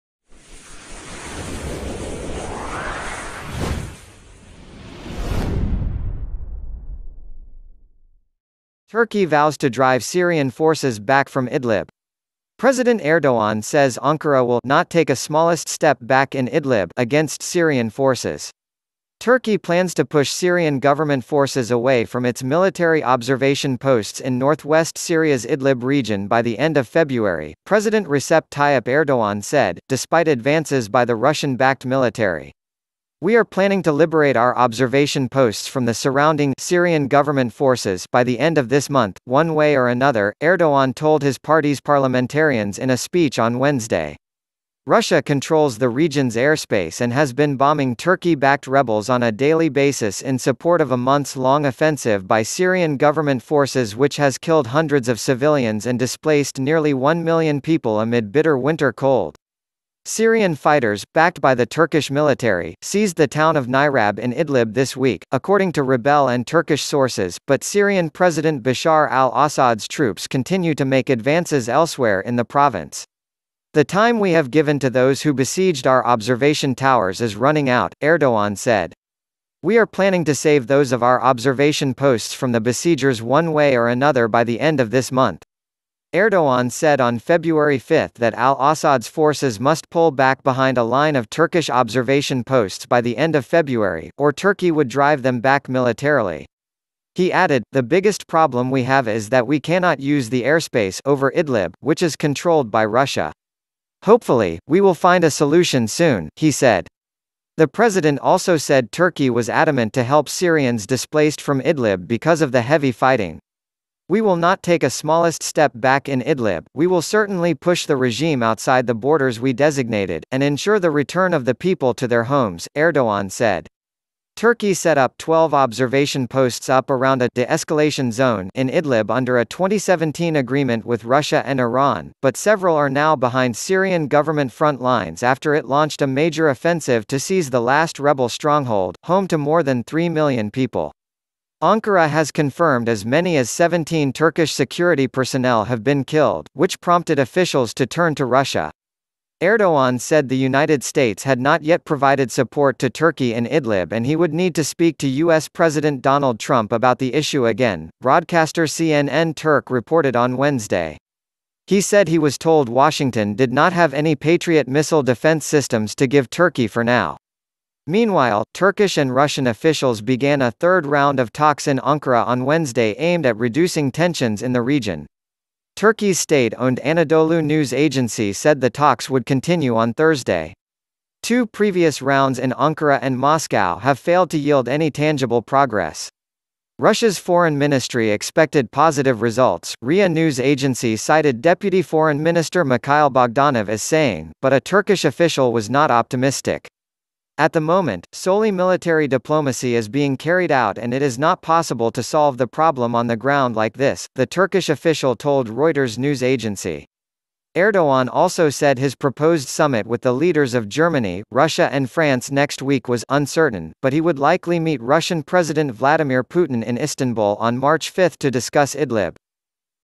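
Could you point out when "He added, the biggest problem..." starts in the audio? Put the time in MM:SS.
01:37.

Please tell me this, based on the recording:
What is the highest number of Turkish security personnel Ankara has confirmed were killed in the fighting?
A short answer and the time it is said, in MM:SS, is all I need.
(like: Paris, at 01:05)
17, at 02:23.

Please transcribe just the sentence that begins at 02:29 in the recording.
Erdogan said the United States had not yet provided support to Turkey in Idlib and he would need to speak to U.S.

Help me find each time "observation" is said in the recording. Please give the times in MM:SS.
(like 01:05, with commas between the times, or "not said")
00:23, 00:34, 01:16, 01:21, 01:31, 02:05.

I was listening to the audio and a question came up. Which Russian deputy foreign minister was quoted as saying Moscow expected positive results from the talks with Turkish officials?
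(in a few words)
Mikhail Bogdanov.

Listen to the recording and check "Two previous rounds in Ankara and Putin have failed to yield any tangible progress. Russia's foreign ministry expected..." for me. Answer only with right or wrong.
wrong.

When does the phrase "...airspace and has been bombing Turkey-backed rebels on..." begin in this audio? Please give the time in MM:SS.
00:46.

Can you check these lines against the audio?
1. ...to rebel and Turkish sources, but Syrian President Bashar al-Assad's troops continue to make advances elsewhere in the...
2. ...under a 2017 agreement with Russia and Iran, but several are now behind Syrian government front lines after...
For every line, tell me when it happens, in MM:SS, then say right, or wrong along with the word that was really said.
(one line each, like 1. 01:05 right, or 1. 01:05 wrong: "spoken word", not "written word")
1. 01:05 right
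2. 02:09 right.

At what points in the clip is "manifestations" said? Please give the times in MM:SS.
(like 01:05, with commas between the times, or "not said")
not said.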